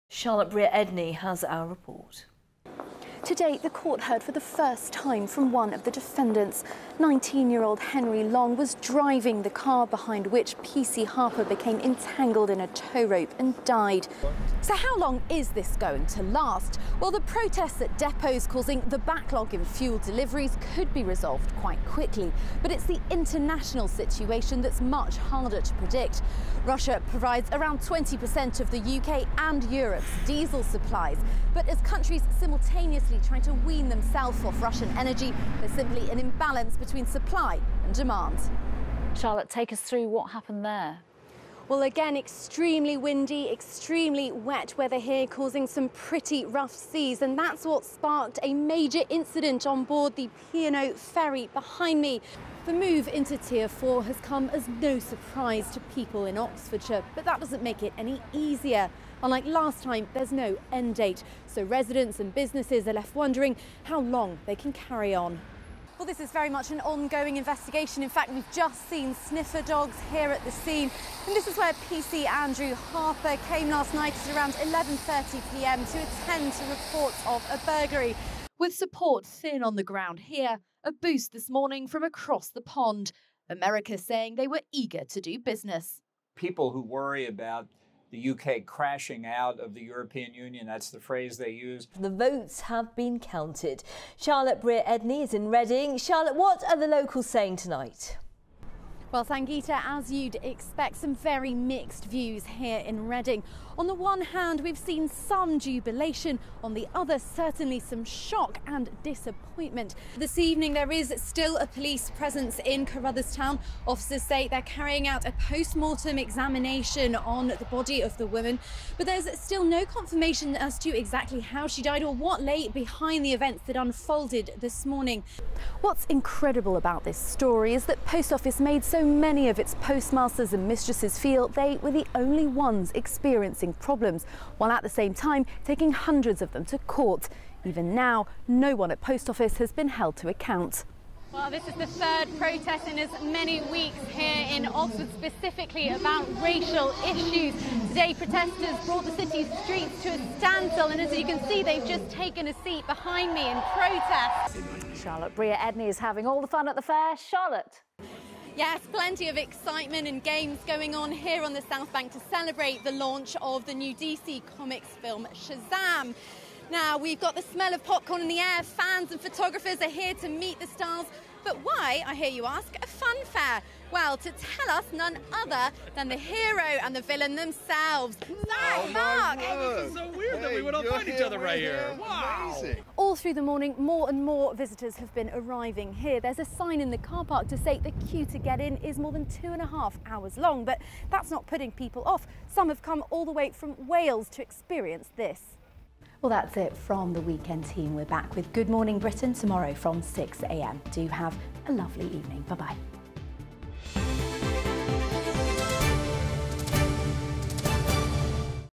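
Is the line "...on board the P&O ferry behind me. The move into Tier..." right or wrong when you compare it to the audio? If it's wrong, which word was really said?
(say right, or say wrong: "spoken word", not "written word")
right.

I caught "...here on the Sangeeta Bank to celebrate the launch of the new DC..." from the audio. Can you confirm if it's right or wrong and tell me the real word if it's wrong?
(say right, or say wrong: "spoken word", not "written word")
wrong: "South", not "Sangeeta".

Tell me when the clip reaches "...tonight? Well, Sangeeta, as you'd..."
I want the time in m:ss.
1:37.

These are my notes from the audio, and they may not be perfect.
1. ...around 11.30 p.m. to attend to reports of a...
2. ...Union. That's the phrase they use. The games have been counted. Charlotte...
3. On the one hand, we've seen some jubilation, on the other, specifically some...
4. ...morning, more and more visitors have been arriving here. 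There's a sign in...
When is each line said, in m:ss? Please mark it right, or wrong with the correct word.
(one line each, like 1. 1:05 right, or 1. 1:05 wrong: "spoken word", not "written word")
1. 1:14 right
2. 1:30 wrong: "votes", not "games"
3. 1:43 wrong: "certainly", not "specifically"
4. 3:03 right.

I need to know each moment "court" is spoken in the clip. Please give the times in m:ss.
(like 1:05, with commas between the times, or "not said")
0:03, 2:16.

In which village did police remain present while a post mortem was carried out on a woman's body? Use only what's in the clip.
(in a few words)
Carrutherstown.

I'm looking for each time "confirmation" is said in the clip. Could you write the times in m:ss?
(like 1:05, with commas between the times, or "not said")
1:59.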